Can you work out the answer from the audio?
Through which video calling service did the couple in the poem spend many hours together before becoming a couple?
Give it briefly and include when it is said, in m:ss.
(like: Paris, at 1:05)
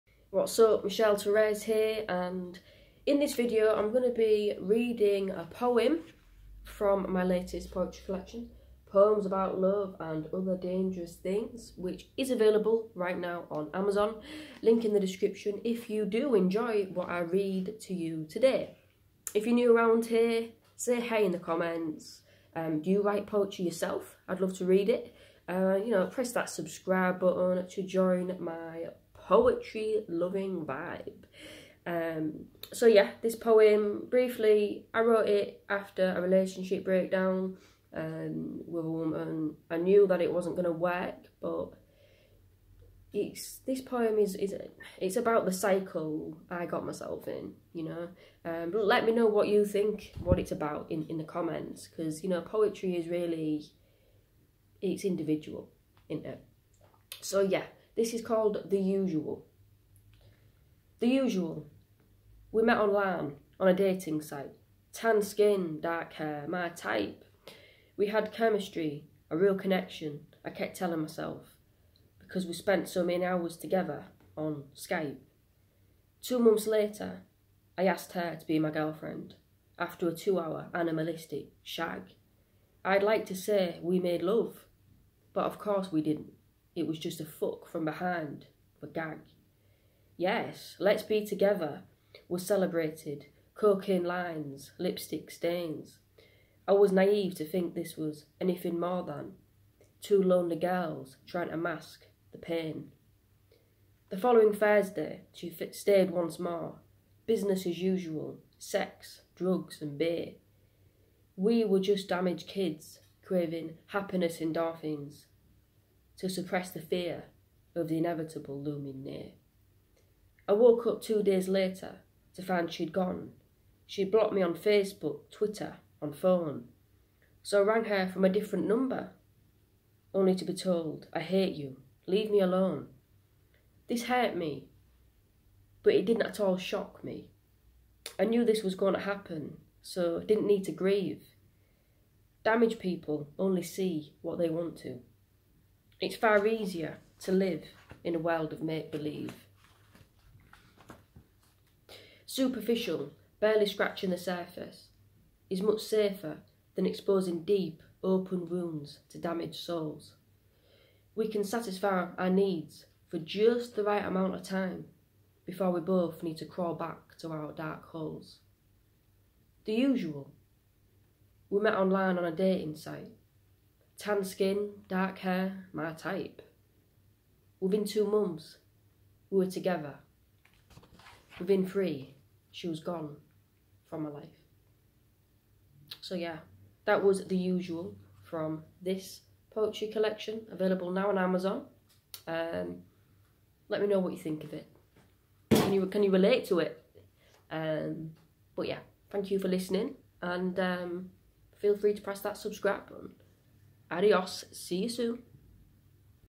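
Skype, at 1:14.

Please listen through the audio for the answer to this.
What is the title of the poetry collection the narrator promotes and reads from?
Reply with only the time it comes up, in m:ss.
0:08.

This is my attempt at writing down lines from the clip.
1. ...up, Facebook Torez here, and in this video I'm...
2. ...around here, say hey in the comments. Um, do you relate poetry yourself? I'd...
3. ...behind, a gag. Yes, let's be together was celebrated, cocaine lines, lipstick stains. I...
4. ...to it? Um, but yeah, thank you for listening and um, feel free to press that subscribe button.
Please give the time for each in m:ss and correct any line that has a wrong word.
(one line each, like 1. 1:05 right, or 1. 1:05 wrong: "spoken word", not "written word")
1. 0:00 wrong: "Michelle", not "Facebook"
2. 0:19 wrong: "write", not "relate"
3. 1:27 right
4. 3:16 right.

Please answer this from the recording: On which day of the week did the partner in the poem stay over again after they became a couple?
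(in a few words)
Thursday.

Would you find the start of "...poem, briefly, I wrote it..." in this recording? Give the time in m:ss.
0:33.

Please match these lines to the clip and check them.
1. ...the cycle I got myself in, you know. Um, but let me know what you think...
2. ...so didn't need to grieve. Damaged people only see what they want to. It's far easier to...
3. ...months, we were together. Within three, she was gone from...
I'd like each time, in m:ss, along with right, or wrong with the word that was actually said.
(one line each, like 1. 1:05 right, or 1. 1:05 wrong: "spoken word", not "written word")
1. 0:45 right
2. 2:19 right
3. 2:58 right.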